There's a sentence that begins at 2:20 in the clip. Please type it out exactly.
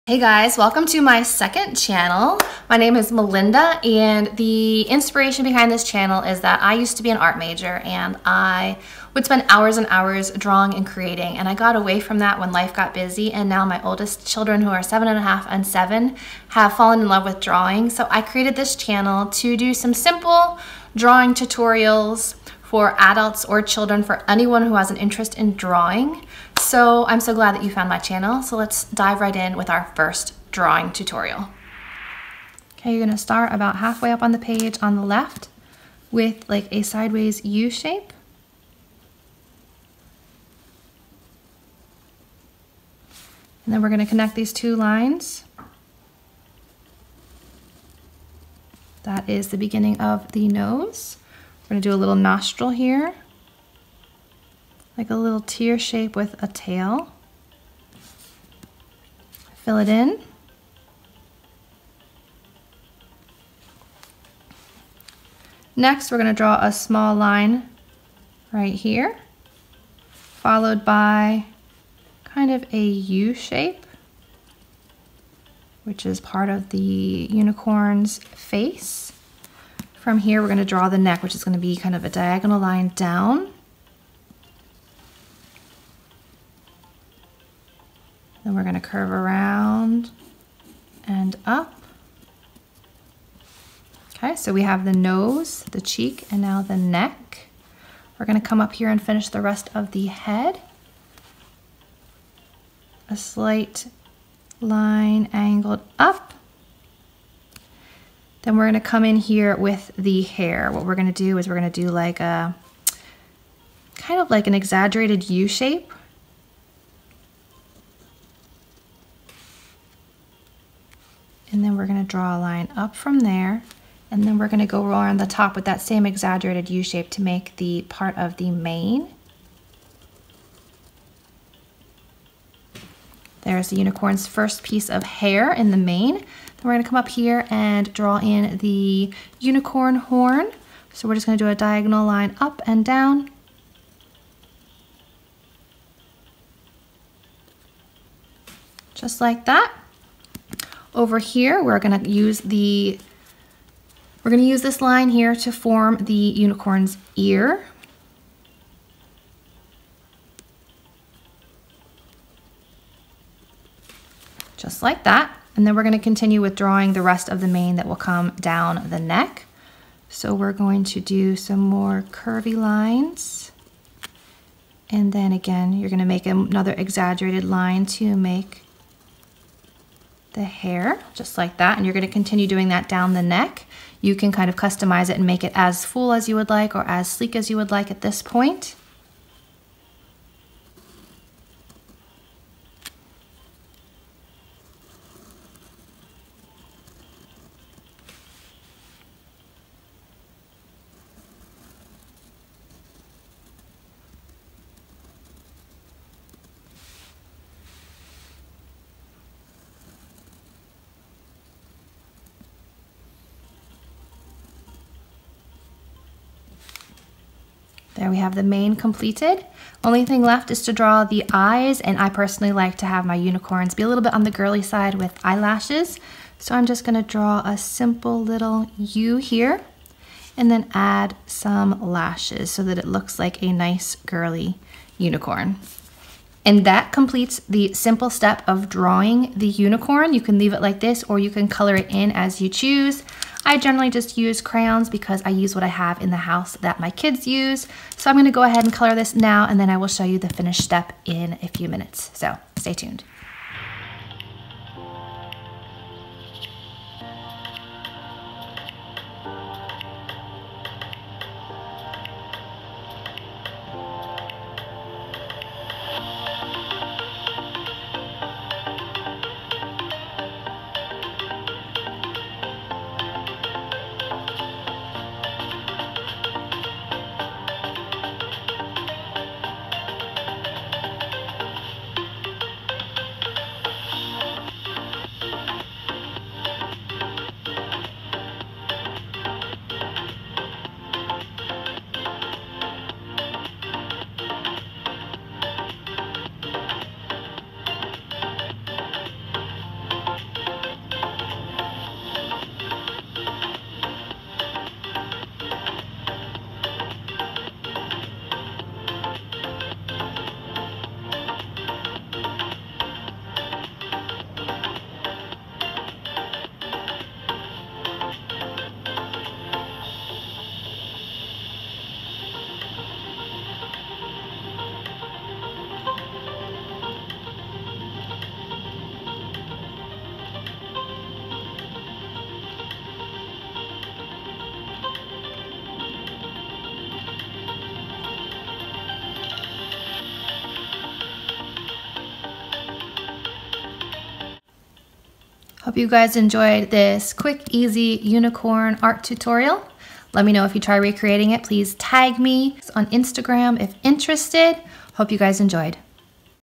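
So we're just gonna do a diagonal line up and down.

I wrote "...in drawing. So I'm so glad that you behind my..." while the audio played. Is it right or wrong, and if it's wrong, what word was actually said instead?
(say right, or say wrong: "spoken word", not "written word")
wrong: "found", not "behind".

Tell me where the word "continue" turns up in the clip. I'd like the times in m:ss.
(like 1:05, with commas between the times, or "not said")
2:45, 3:02.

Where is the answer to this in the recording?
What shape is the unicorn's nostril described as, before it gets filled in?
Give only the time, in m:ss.
0:55.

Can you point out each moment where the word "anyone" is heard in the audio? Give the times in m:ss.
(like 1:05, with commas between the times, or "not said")
0:24.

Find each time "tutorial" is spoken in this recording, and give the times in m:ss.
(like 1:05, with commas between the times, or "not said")
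0:21, 0:30, 5:49.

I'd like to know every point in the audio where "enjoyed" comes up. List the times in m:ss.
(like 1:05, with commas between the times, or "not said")
5:46, 5:55.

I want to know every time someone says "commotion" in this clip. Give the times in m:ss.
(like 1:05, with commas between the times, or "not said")
not said.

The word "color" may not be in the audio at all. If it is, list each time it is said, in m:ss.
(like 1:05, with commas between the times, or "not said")
4:01, 4:08.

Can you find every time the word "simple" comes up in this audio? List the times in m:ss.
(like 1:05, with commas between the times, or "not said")
0:19, 3:47, 3:57.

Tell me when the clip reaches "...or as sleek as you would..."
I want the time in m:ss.
3:06.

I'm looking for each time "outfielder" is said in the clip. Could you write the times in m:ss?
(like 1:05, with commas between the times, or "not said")
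not said.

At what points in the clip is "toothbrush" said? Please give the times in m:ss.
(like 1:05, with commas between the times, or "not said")
not said.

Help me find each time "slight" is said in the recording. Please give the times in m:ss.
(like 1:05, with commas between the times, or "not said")
1:43.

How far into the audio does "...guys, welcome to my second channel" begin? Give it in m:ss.
0:00.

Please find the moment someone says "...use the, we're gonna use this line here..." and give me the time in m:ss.
2:32.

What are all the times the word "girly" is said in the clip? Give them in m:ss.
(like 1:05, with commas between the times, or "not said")
3:44, 3:54.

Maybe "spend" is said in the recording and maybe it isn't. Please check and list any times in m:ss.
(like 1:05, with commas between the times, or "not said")
0:09.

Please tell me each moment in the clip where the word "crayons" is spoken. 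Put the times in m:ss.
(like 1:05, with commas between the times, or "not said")
4:04.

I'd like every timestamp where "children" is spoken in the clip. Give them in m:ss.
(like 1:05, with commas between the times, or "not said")
0:14, 0:23.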